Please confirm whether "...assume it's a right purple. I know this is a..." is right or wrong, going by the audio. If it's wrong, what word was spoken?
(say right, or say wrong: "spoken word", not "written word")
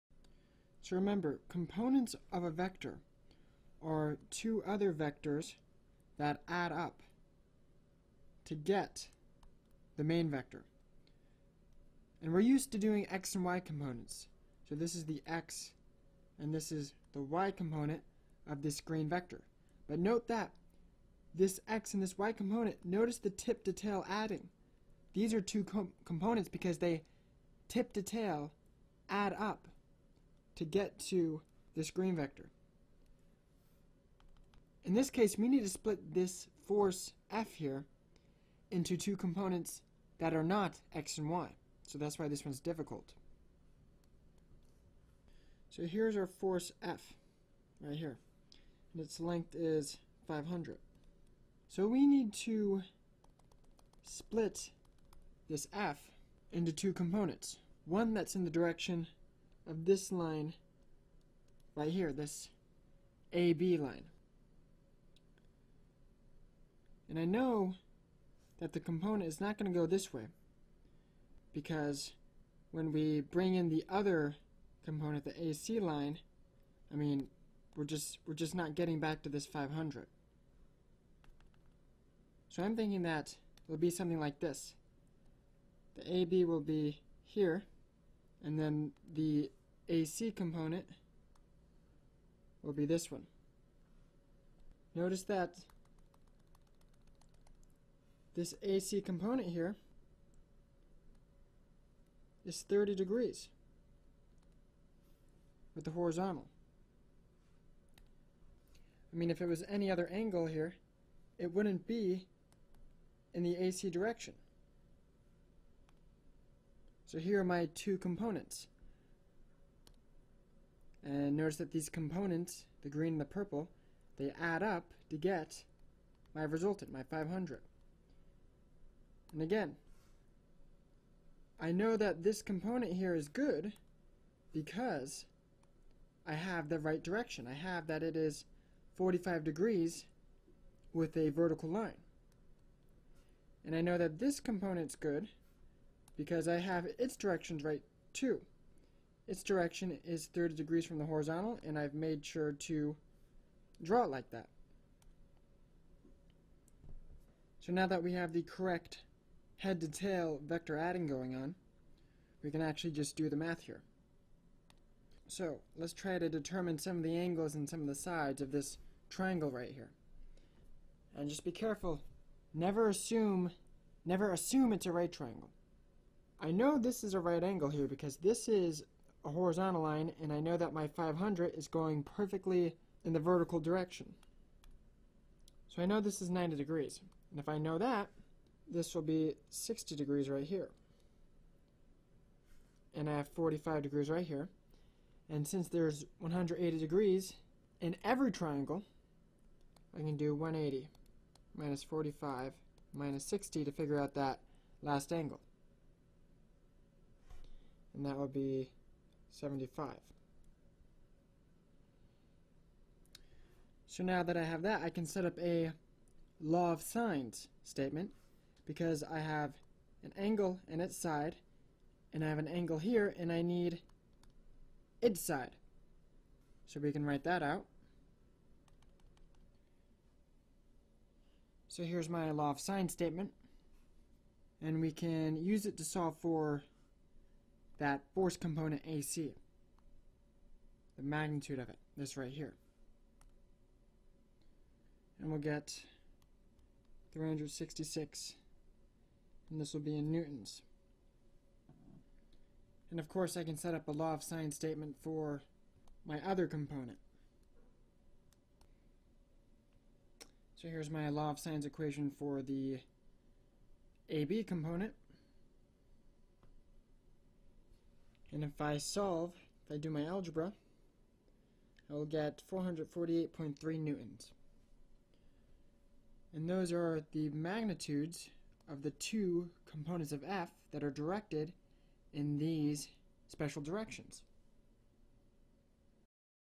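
wrong: "triangle", not "purple".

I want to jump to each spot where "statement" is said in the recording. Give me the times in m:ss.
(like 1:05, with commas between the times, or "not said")
3:37, 3:52, 4:14.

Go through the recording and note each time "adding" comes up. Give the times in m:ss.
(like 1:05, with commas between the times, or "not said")
0:24, 2:40.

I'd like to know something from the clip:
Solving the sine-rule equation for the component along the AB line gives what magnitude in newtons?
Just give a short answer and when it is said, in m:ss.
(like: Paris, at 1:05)
448.3, at 4:32.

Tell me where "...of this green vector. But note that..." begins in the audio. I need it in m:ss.
0:18.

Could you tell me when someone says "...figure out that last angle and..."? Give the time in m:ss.
3:23.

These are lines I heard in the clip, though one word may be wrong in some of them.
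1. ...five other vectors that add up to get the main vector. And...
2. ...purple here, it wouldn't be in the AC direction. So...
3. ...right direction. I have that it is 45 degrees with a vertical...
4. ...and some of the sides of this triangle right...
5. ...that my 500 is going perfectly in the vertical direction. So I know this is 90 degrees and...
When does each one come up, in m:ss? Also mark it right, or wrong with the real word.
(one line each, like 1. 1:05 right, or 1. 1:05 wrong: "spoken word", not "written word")
1. 0:04 wrong: "two", not "five"
2. 1:50 wrong: "angle", not "purple"
3. 2:16 right
4. 2:47 right
5. 3:00 right.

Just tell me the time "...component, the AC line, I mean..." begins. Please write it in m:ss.
1:14.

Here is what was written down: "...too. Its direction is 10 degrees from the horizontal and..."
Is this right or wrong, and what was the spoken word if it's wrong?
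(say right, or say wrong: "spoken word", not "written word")
wrong: "30", not "10".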